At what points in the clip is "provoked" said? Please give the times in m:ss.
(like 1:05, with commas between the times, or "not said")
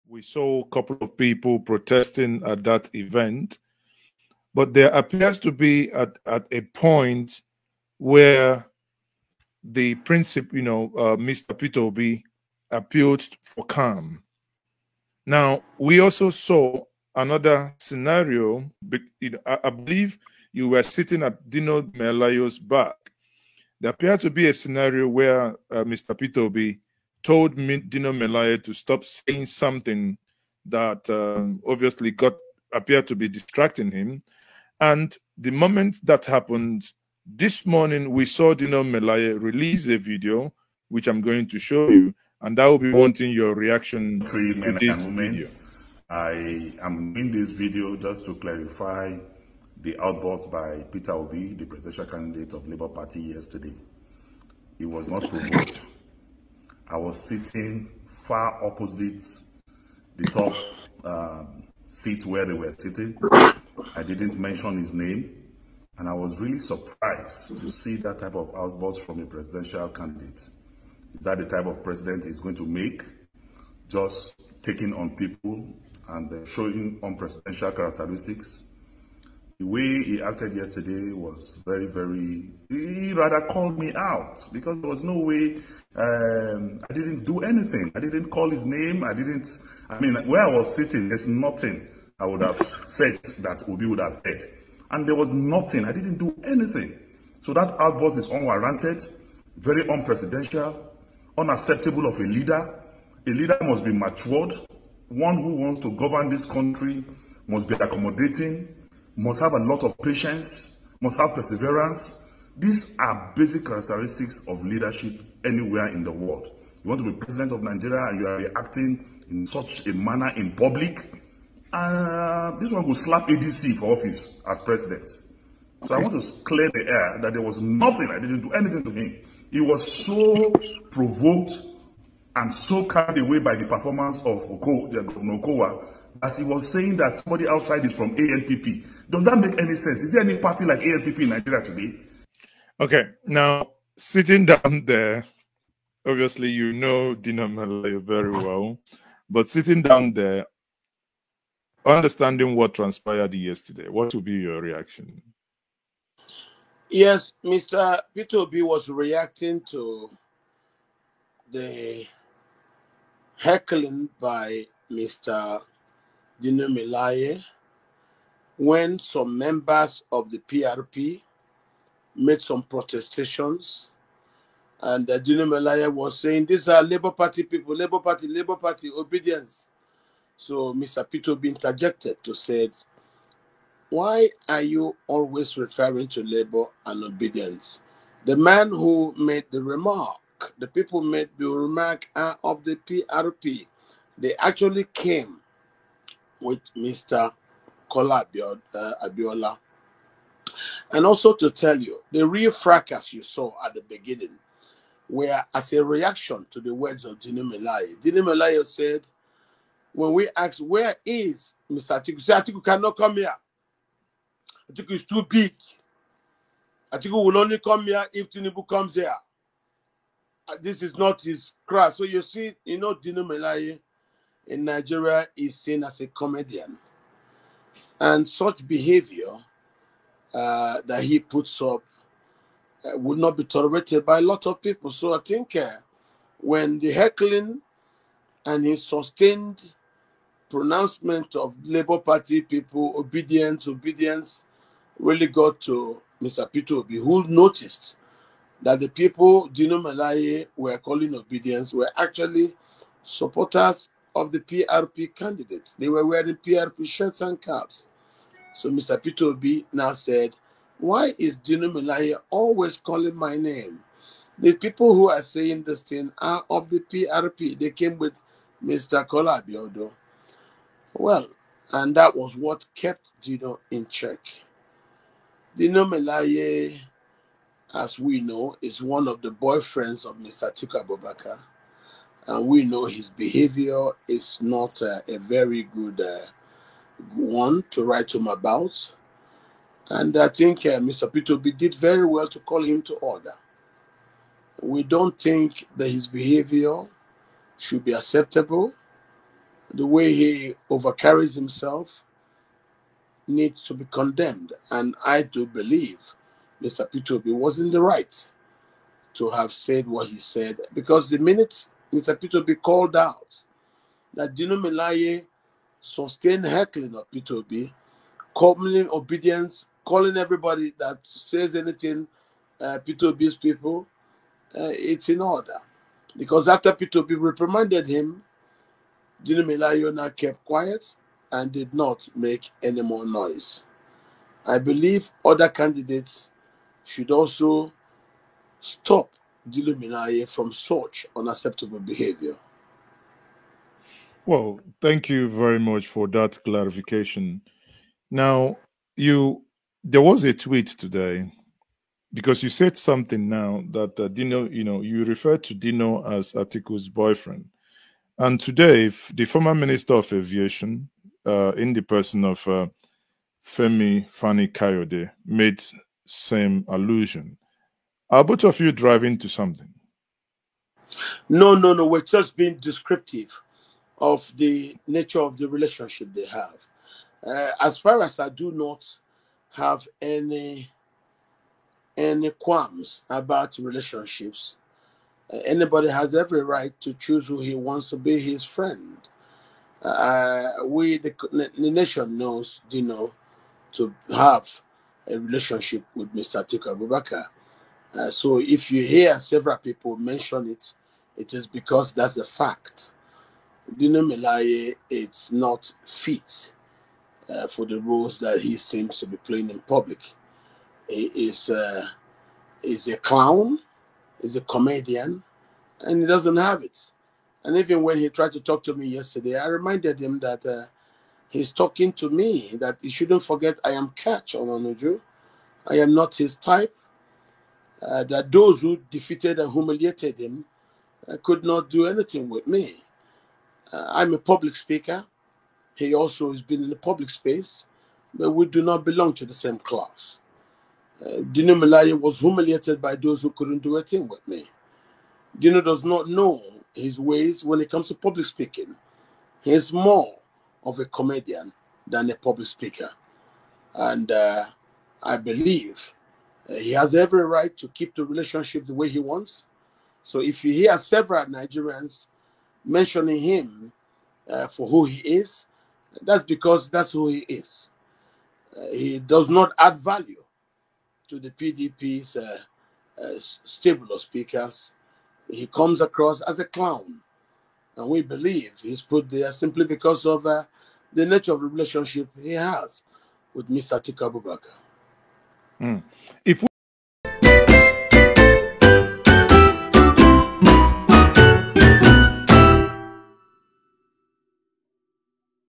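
0:55, 2:10.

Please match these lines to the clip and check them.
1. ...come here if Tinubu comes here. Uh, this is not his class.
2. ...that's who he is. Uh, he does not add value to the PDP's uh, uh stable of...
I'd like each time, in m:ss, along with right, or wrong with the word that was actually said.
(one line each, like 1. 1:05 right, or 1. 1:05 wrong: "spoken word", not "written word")
1. 3:37 right
2. 7:46 right.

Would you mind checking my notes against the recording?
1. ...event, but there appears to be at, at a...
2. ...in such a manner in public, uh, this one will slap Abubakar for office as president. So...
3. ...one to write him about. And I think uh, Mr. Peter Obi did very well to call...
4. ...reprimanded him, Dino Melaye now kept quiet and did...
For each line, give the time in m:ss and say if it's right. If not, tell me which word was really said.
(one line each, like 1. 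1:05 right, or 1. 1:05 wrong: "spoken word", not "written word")
1. 0:02 right
2. 1:59 wrong: "ADC", not "Abubakar"
3. 4:47 right
4. 5:27 right.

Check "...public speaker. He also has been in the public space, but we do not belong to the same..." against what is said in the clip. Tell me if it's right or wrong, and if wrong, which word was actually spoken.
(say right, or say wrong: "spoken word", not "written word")
right.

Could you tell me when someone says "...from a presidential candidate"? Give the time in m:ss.
1:09.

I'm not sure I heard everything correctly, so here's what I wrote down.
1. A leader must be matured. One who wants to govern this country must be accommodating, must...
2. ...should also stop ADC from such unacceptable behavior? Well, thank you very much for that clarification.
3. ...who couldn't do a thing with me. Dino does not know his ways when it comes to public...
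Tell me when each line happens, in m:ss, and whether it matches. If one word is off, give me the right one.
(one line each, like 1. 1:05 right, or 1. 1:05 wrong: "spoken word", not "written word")
1. 1:43 right
2. 5:36 wrong: "Gilo", not "ADC"
3. 7:23 right.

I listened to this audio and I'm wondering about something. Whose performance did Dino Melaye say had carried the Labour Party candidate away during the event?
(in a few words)
Governor Okowa.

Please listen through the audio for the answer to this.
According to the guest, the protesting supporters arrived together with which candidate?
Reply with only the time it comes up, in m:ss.
3:17.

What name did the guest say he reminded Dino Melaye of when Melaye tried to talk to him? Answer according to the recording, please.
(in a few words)
Katch Ononuju.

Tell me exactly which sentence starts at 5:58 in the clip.
And today, the former Minister of Aviation, uh, in the person of uh, Femi Fani Kayode, made same allusion.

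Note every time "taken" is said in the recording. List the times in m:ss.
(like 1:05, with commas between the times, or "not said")
not said.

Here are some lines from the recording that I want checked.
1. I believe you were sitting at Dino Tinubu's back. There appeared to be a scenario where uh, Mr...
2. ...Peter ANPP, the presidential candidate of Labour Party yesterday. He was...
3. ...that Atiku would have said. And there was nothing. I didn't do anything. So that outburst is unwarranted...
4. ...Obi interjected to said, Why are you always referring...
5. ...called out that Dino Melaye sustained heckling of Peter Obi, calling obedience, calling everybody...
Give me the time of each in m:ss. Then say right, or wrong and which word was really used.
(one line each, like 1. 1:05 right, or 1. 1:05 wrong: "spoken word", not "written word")
1. 0:19 wrong: "Melaye", not "Tinubu"
2. 0:50 wrong: "Obi", not "ANPP"
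3. 1:33 wrong: "Obi", not "Atiku"
4. 3:01 right
5. 5:12 right.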